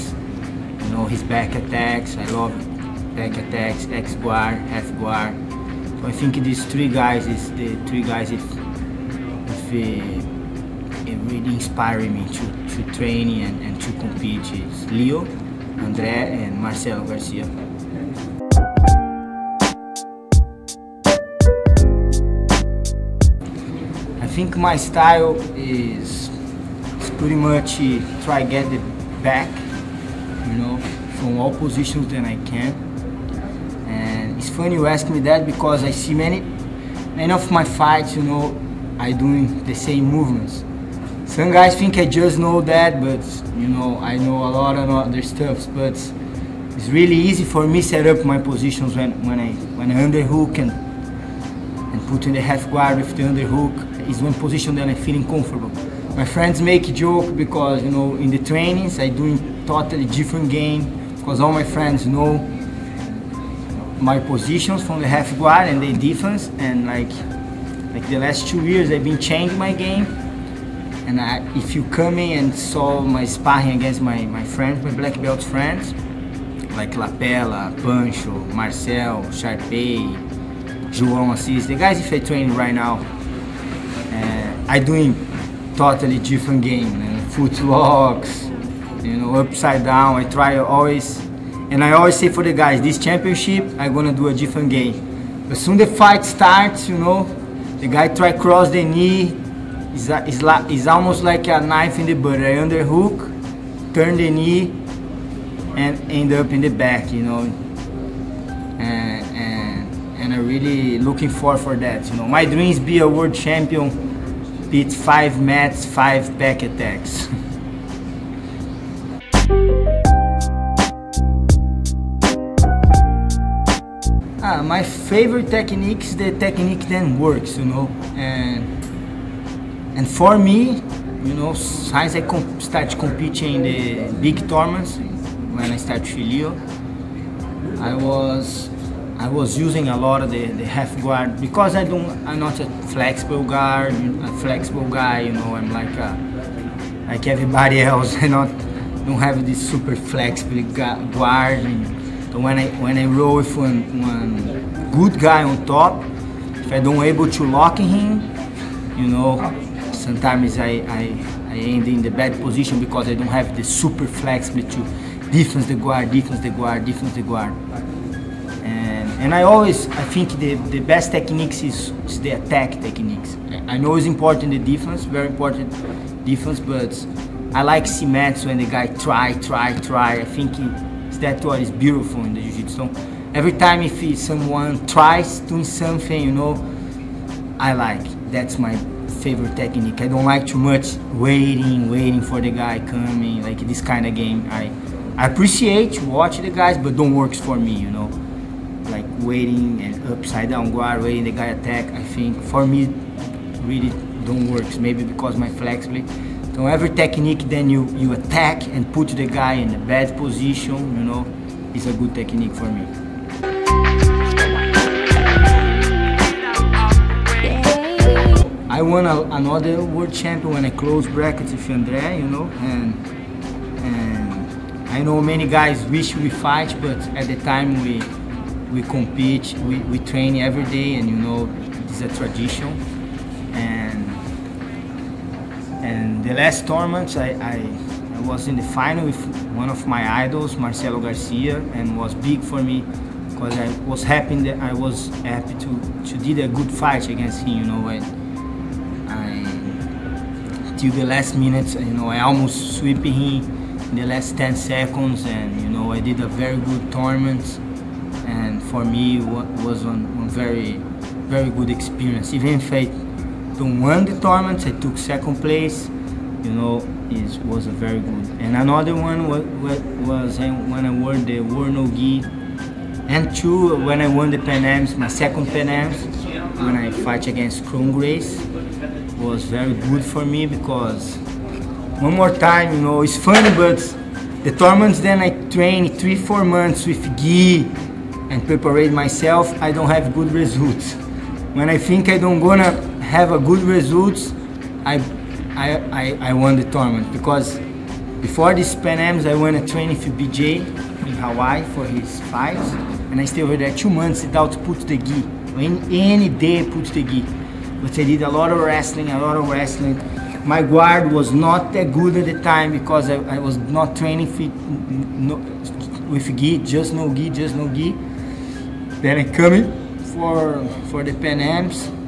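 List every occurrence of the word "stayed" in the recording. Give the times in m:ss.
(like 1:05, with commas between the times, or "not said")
5:03.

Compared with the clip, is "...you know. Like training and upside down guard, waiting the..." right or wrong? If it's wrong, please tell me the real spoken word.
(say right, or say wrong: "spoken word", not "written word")
wrong: "waiting", not "training".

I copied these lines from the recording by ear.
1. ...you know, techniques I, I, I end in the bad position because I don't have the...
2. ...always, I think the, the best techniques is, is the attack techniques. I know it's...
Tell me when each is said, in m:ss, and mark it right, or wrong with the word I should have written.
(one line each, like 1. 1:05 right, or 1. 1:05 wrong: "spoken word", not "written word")
1. 2:38 wrong: "sometimes", not "techniques"
2. 2:49 right.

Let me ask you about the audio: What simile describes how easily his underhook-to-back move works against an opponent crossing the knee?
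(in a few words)
A knife in the butter.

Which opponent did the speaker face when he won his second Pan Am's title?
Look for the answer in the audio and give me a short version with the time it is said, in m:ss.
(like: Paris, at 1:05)
Kron Gracie, at 4:37.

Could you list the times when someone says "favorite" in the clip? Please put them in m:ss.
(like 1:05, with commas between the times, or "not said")
2:04, 3:09.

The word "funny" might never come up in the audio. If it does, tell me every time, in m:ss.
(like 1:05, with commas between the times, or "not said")
0:34, 4:43.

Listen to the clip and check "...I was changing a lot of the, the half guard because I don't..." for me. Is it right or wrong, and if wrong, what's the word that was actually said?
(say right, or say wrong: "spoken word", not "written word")
wrong: "using", not "changing".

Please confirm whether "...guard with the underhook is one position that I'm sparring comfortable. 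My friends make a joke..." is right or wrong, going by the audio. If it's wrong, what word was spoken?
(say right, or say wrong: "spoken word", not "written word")
wrong: "feeling", not "sparring".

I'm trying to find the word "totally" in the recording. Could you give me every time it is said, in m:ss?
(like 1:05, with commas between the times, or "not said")
0:59, 1:25.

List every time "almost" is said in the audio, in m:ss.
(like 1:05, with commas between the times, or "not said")
1:40, 4:12.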